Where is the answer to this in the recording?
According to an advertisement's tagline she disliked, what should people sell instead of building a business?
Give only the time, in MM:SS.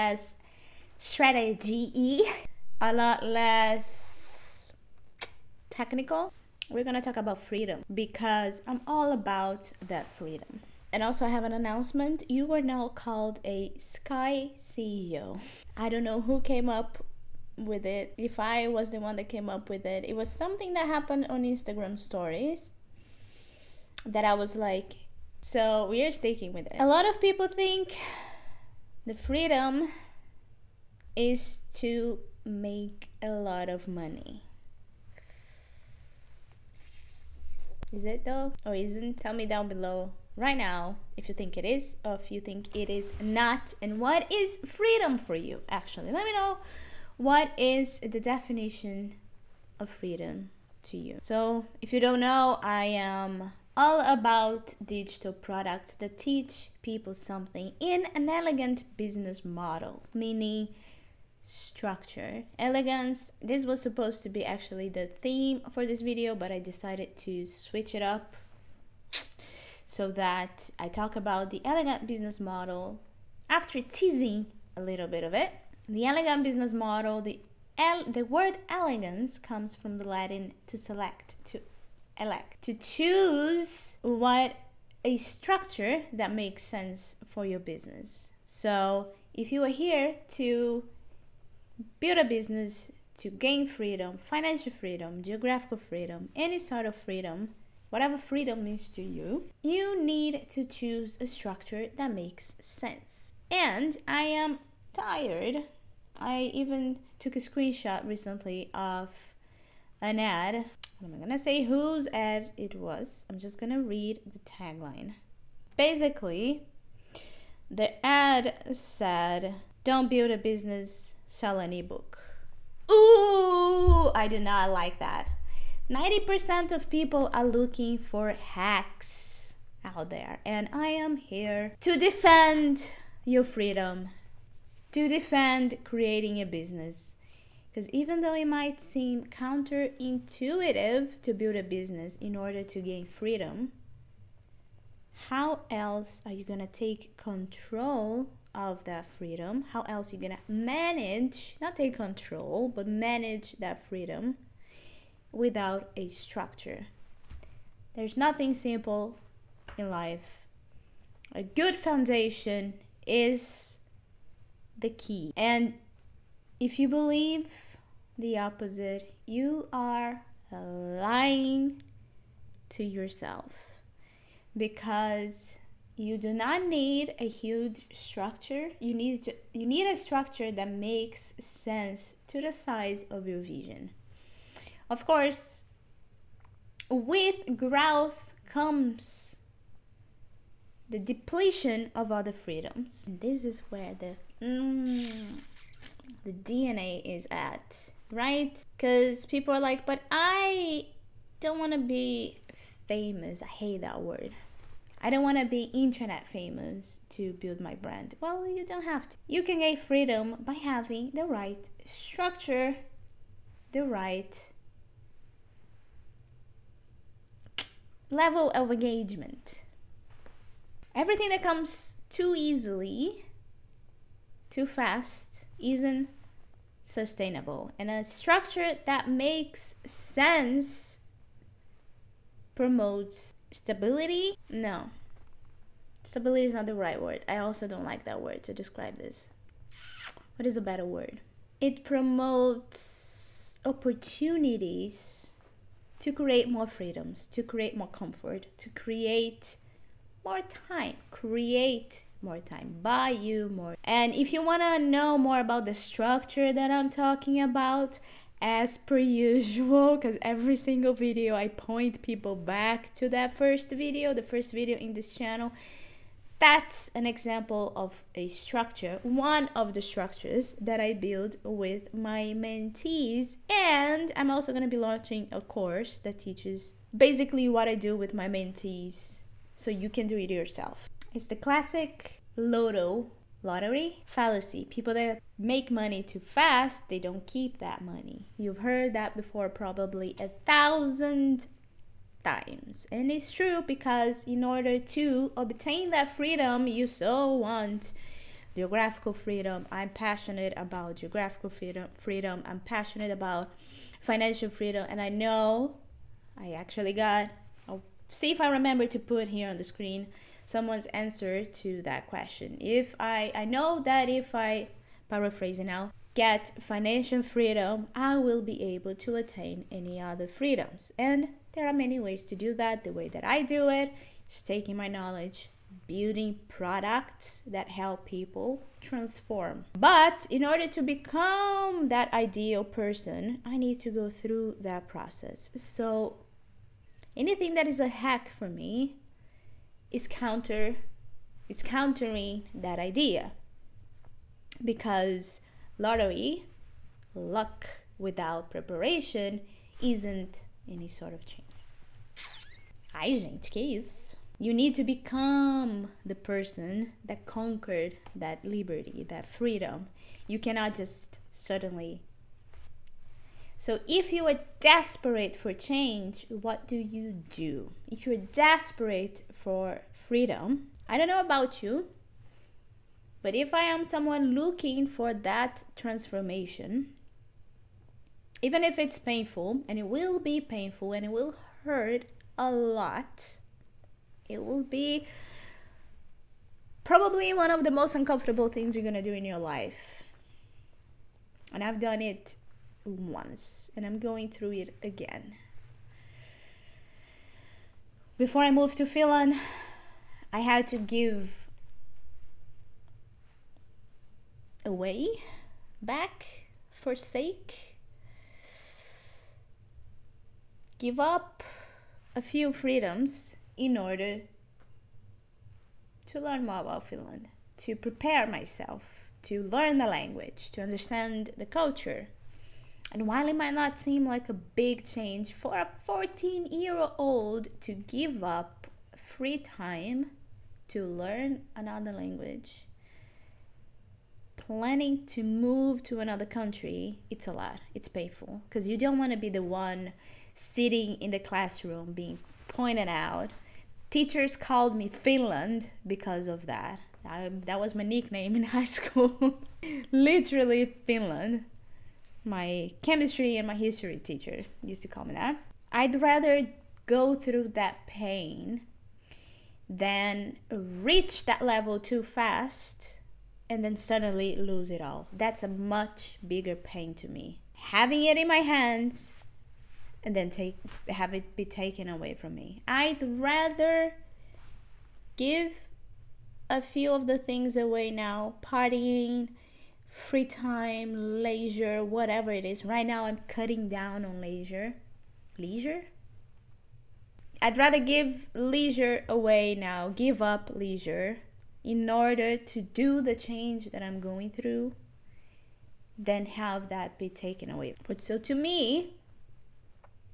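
02:01.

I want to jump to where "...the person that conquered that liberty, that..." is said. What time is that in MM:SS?
05:56.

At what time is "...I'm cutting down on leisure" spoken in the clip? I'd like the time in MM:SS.
08:03.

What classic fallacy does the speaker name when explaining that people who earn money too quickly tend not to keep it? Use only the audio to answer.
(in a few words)
Lottery fallacy.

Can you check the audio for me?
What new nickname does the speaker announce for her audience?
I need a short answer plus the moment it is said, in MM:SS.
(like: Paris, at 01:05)
Sky CEO, at 00:13.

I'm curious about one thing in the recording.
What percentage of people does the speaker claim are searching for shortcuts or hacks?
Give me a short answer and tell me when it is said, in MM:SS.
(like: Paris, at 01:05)
90%, at 02:05.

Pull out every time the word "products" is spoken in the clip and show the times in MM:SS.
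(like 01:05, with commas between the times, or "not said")
00:55, 05:26.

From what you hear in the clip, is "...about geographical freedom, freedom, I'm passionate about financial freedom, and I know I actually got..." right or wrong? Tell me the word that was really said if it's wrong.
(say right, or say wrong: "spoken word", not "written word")
right.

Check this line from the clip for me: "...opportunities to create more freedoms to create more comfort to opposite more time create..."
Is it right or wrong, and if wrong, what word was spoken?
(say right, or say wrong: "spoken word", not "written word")
wrong: "create", not "opposite".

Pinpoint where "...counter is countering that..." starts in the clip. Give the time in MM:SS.
05:40.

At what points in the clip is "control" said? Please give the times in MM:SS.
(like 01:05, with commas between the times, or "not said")
02:27, 02:31.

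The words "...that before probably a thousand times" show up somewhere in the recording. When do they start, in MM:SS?
04:48.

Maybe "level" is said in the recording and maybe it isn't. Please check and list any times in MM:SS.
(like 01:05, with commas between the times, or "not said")
03:38, 07:41.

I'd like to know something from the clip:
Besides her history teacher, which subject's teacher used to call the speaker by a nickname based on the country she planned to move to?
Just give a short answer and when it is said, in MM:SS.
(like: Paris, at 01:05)
Chemistry, at 07:32.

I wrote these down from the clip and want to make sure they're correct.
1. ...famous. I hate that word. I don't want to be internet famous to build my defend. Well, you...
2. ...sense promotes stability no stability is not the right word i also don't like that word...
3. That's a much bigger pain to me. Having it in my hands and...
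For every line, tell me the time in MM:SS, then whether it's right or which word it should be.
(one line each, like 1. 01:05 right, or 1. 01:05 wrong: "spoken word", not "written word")
1. 03:22 wrong: "brand", not "defend"
2. 03:49 right
3. 07:45 right.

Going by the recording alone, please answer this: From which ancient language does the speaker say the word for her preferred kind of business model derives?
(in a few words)
Latin.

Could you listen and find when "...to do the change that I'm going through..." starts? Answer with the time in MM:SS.
08:12.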